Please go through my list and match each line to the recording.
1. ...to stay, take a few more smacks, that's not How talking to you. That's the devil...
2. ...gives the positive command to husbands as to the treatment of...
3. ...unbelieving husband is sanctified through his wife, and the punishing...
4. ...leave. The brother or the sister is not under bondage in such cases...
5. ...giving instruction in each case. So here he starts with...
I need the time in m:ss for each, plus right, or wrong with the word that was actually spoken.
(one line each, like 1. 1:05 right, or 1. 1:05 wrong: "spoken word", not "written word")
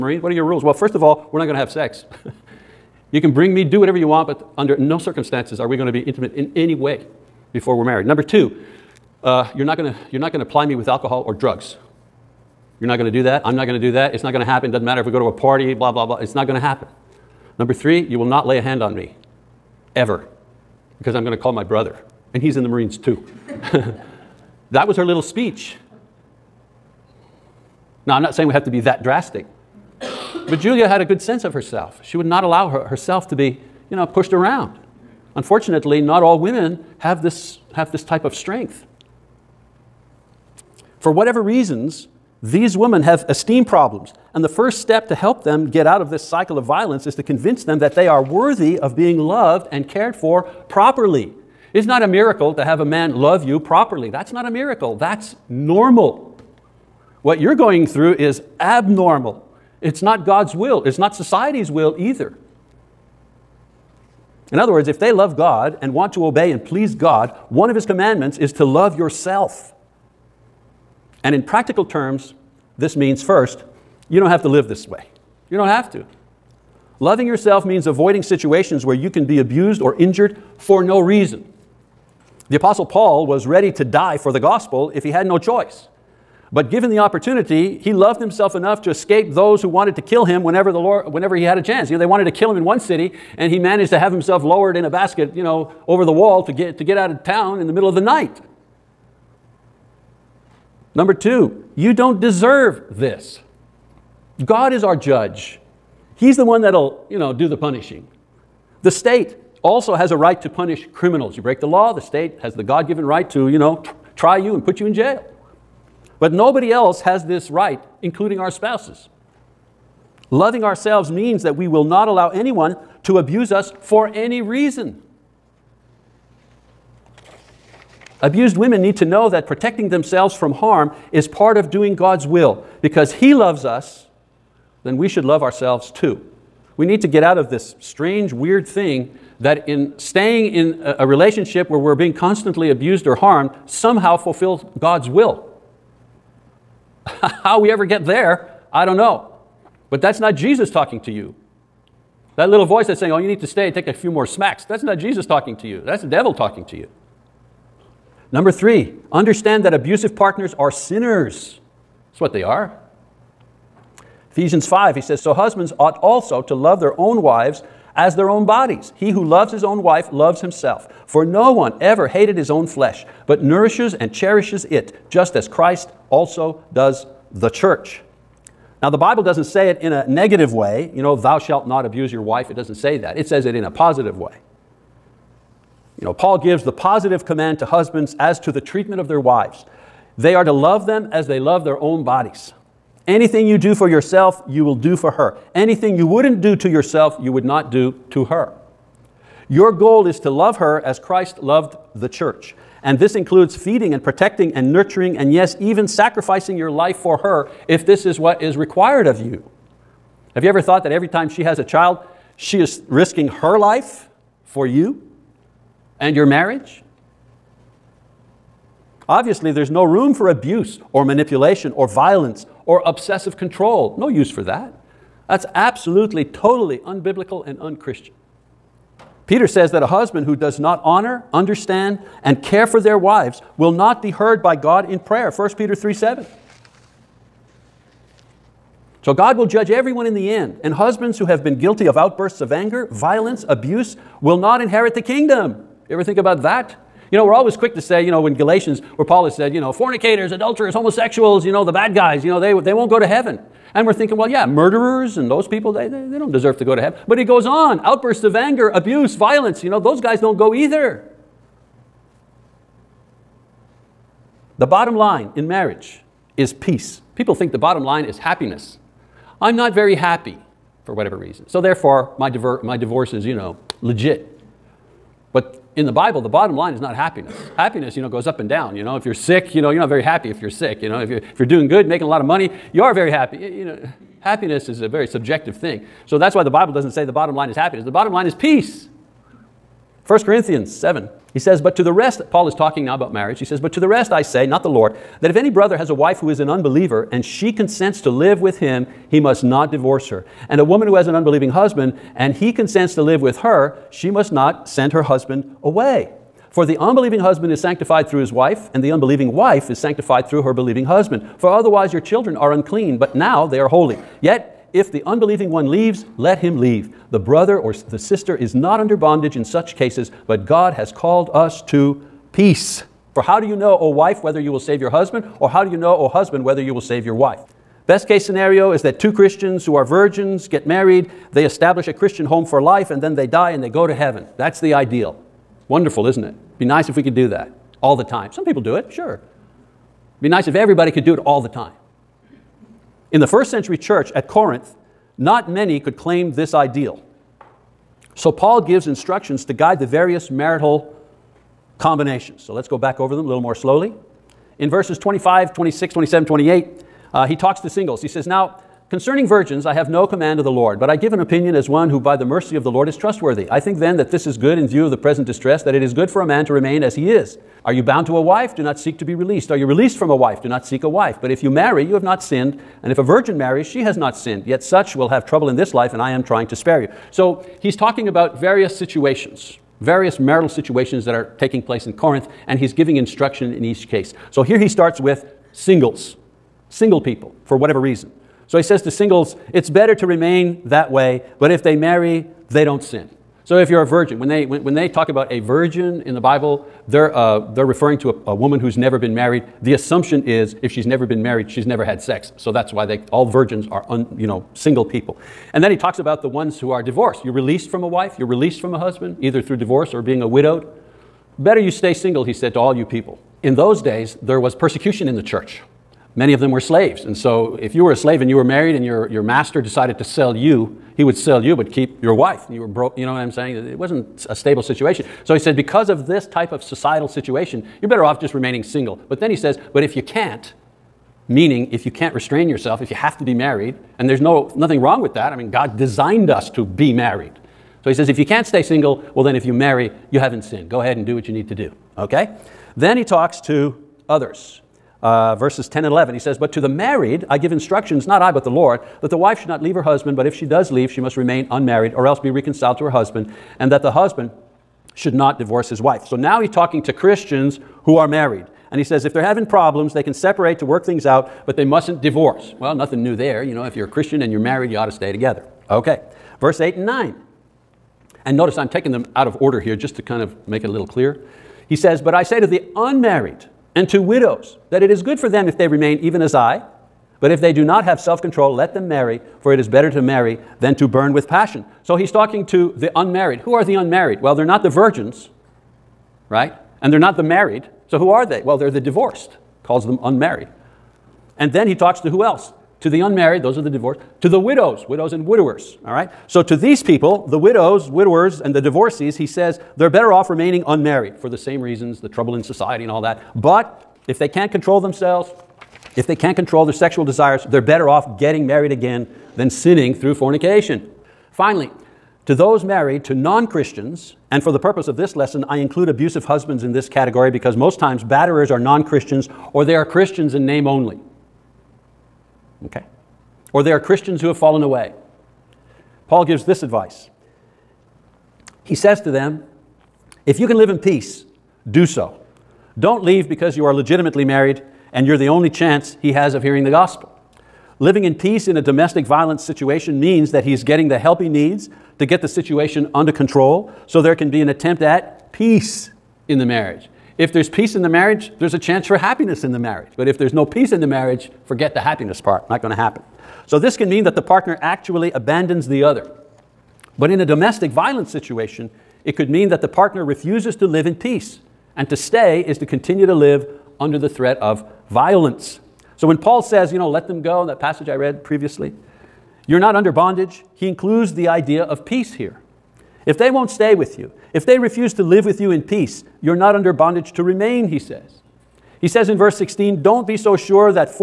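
1. 2:33 wrong: "Jesus", not "How"
2. 3:06 right
3. 5:06 wrong: "unbelieving", not "punishing"
4. 5:16 right
5. 6:22 right.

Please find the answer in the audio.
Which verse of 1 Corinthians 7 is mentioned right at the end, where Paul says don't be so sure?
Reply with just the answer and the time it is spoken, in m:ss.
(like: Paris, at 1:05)
Verse 16, at 9:39.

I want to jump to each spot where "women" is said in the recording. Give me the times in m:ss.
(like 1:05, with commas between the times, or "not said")
0:36, 0:42, 2:08.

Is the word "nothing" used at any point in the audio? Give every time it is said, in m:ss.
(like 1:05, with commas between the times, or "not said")
7:14, 7:42.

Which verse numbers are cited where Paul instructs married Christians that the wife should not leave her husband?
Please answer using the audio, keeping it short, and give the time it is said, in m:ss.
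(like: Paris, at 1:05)
Verses 10 and 11, at 7:25.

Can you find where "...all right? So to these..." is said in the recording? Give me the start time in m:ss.
8:15.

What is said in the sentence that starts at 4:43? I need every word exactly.
You know, happiness is a very subjective thing.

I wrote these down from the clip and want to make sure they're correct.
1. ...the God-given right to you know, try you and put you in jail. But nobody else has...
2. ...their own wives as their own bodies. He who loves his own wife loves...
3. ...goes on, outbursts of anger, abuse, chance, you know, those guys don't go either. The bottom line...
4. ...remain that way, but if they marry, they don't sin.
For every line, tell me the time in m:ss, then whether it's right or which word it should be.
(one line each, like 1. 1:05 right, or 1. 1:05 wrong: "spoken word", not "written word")
1. 1:52 right
2. 2:46 right
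3. 4:17 wrong: "violence", not "chance"
4. 6:30 right.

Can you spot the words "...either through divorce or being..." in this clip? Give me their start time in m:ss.
6:49.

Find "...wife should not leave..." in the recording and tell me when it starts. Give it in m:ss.
7:29.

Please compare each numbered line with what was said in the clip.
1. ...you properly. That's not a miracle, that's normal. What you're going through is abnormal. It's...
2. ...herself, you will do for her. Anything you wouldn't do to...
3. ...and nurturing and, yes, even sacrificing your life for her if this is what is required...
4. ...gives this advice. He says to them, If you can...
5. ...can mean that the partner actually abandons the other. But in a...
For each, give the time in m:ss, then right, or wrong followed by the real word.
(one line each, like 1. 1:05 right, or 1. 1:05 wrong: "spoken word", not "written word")
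1. 0:53 right
2. 3:13 wrong: "yourself", not "herself"
3. 3:24 right
4. 8:46 right
5. 9:13 right.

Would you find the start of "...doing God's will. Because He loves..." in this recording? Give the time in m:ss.
2:11.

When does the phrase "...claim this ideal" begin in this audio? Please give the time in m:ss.
5:45.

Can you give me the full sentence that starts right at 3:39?
Obviously, there's no room for abuse or manipulation or violence or obsessive control.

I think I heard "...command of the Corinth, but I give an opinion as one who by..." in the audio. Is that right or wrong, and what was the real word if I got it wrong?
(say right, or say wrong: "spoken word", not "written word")
wrong: "Lord", not "Corinth".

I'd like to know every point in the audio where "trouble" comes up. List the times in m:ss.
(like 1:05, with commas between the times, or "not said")
6:15, 8:22.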